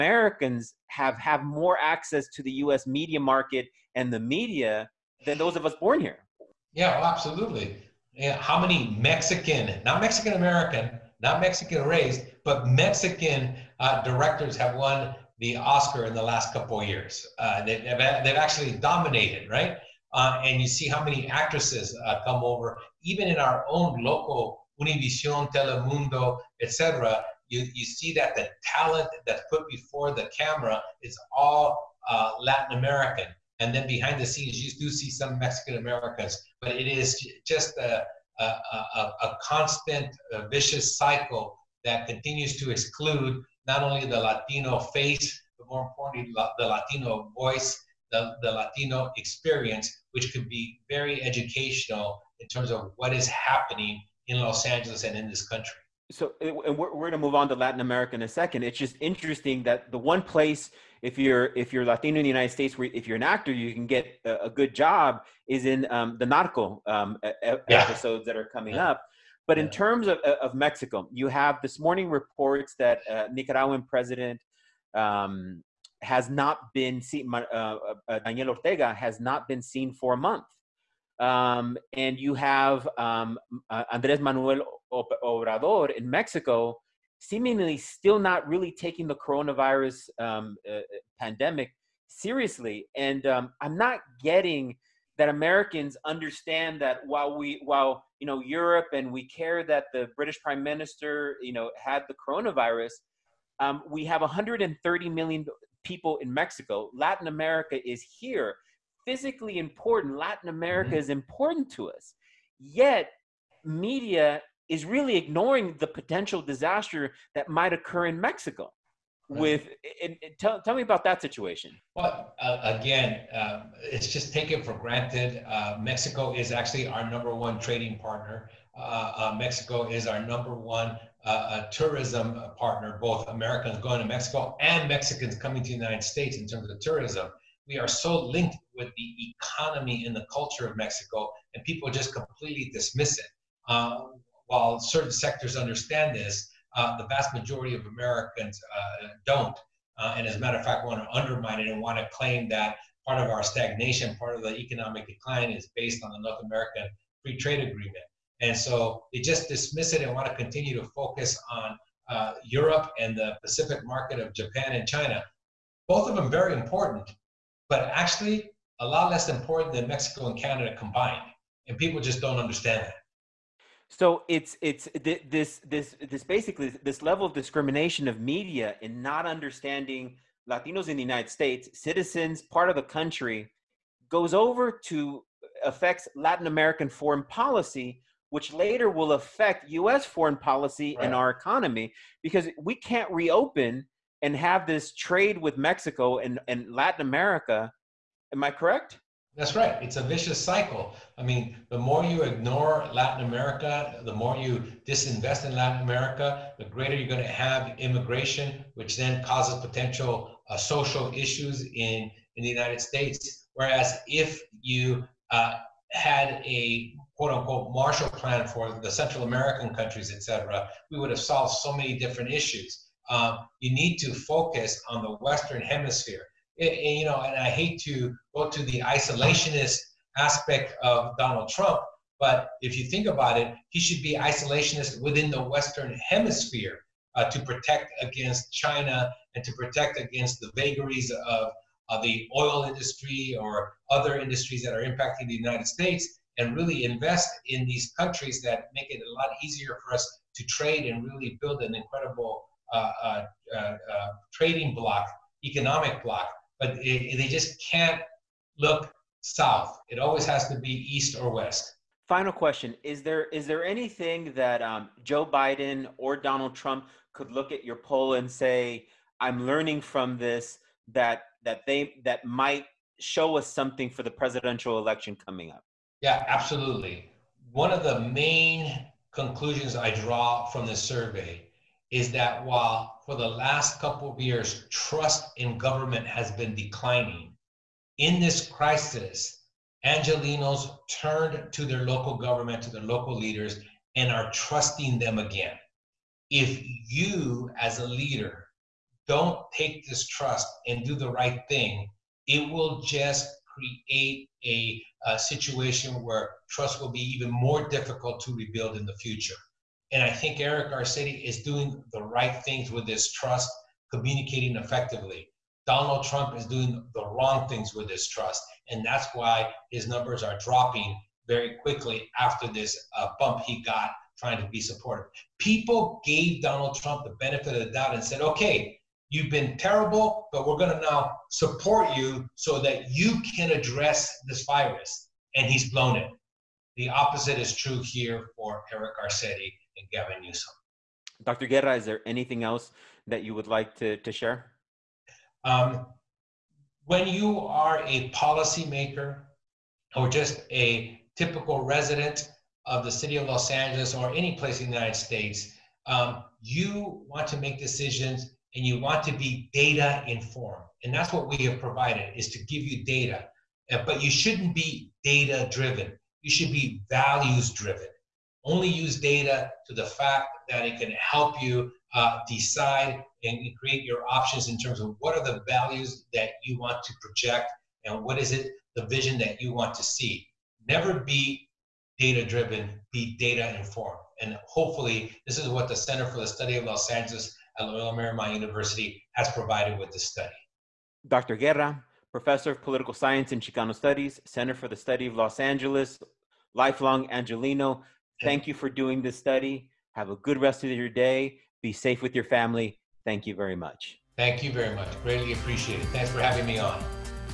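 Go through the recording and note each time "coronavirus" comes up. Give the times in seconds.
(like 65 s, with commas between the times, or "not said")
89 s, 102 s.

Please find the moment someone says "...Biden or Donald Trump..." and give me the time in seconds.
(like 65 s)
265 s.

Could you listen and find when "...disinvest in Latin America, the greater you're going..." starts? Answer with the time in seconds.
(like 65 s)
204 s.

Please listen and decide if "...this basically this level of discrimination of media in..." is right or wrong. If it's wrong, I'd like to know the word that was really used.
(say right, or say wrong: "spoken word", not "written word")
right.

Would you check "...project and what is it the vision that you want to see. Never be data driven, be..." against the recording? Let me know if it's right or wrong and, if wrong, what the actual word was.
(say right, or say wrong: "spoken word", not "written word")
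right.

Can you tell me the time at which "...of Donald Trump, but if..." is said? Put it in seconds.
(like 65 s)
230 s.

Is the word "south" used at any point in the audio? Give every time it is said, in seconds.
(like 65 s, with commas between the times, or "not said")
259 s.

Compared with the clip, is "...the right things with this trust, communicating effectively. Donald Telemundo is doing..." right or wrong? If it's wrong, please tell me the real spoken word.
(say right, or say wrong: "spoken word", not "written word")
wrong: "Trump", not "Telemundo".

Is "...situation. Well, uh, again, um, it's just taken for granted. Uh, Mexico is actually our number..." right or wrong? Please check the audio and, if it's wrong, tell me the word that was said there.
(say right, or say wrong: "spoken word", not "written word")
right.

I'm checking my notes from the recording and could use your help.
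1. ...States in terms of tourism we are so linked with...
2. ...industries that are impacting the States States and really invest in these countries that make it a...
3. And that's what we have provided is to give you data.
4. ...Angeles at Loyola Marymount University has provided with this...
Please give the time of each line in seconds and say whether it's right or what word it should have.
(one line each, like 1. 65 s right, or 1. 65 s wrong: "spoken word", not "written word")
1. 136 s right
2. 244 s wrong: "United", not "States"
3. 360 s right
4. 386 s right.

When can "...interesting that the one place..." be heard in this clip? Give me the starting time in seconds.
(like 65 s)
59 s.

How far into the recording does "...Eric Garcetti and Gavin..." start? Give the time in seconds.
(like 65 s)
338 s.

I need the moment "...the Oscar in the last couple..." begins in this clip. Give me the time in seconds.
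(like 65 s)
15 s.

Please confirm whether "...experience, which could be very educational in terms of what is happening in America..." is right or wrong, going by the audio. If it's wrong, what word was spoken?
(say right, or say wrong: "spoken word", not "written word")
wrong: "Los", not "America".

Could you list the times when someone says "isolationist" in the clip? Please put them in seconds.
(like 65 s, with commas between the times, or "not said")
228 s, 234 s.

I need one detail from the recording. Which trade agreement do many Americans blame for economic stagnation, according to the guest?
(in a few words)
North American Free Trade Agreement.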